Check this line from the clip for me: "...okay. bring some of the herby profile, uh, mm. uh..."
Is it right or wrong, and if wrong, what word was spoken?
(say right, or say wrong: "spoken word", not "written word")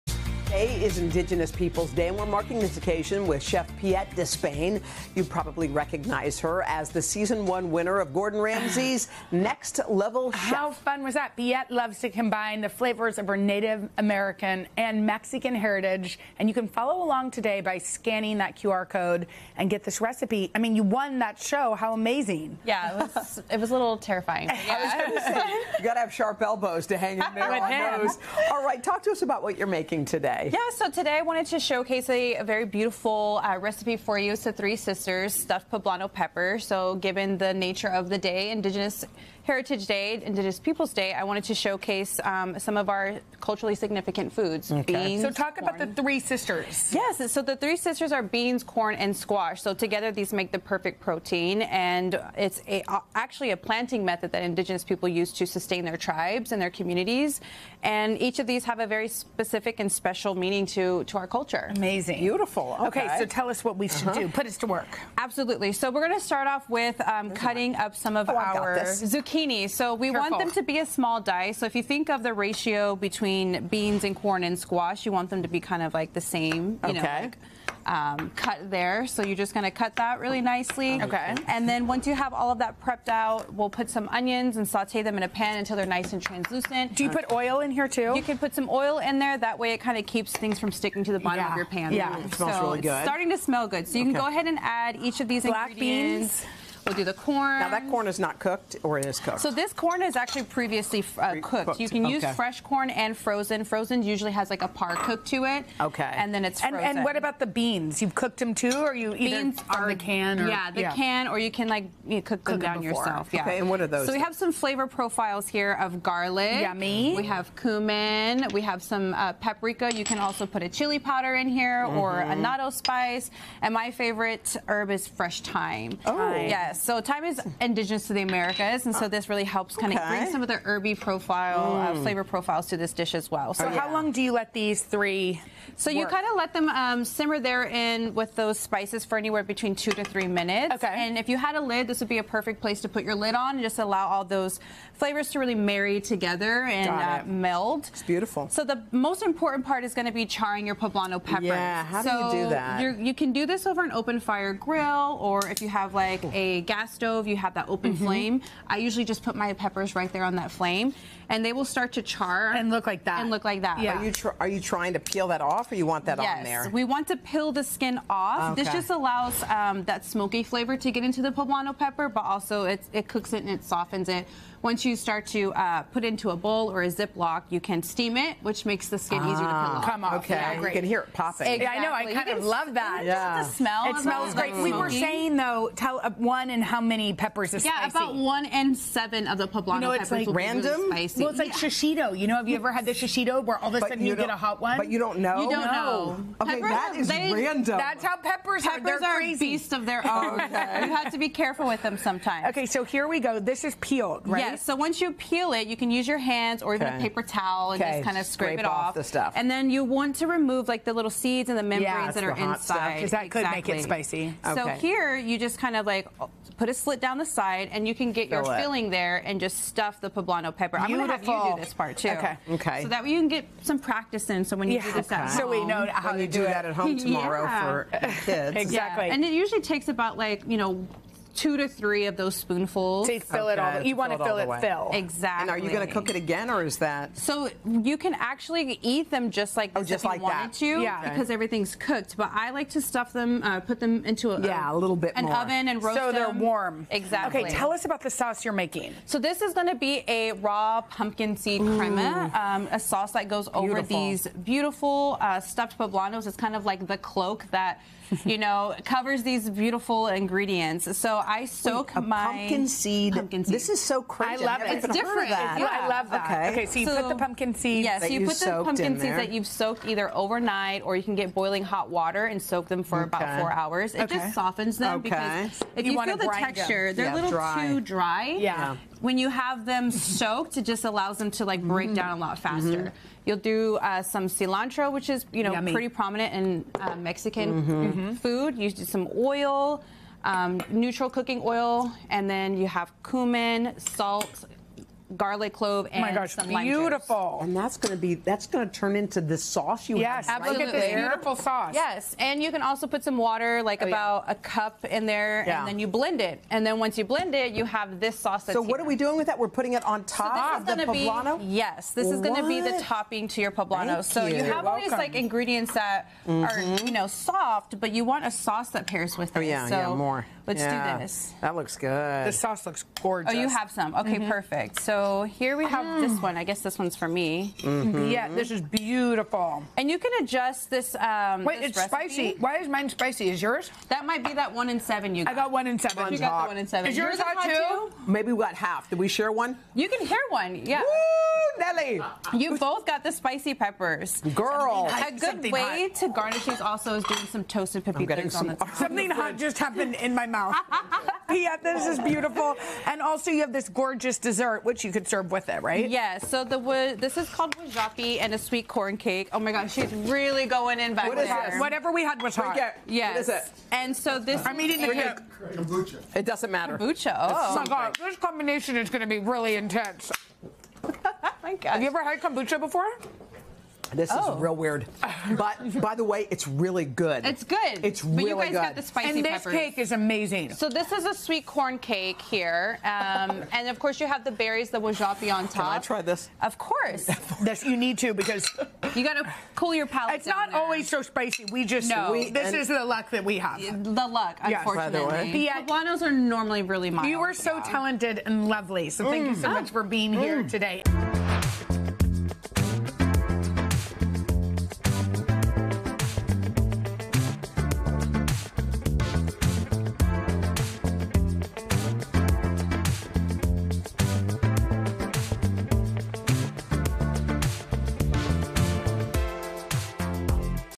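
right.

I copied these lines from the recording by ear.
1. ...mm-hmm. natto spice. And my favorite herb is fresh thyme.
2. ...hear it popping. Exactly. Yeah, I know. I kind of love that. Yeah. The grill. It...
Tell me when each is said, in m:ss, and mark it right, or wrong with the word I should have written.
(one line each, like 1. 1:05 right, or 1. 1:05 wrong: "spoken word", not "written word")
1. 2:02 right
2. 3:00 wrong: "smell", not "grill".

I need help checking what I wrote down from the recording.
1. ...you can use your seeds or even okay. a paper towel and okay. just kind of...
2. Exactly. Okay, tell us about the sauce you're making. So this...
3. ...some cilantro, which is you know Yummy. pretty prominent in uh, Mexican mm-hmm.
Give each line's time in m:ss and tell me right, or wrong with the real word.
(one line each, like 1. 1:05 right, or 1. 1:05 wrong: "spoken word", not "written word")
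1. 3:25 wrong: "hands", not "seeds"
2. 4:06 right
3. 4:44 right.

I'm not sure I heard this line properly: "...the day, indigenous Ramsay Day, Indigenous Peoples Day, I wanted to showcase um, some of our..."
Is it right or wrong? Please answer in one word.
wrong.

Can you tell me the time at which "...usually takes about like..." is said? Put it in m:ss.
3:49.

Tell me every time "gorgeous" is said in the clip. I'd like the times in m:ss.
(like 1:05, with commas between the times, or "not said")
5:23, 5:53.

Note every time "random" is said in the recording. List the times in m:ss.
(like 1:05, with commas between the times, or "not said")
3:10, 3:17.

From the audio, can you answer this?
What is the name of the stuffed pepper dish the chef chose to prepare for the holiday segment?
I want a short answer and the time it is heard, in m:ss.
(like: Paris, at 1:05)
Three Sisters stuffed poblano pepper, at 0:34.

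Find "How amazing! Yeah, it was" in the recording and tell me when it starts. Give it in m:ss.
0:21.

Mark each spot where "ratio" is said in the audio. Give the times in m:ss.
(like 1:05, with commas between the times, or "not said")
1:12.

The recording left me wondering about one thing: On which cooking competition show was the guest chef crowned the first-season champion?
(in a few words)
Next Level Chef.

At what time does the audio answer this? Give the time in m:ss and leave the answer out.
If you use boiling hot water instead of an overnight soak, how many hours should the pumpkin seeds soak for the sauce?
4:33.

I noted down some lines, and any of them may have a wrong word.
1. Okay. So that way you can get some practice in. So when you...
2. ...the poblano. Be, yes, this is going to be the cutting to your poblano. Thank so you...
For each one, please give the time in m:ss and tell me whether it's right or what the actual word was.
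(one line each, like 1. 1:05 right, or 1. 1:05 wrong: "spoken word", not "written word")
1. 3:42 right
2. 5:10 wrong: "topping", not "cutting".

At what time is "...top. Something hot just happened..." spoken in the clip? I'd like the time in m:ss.
5:48.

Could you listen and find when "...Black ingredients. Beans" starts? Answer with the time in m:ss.
1:35.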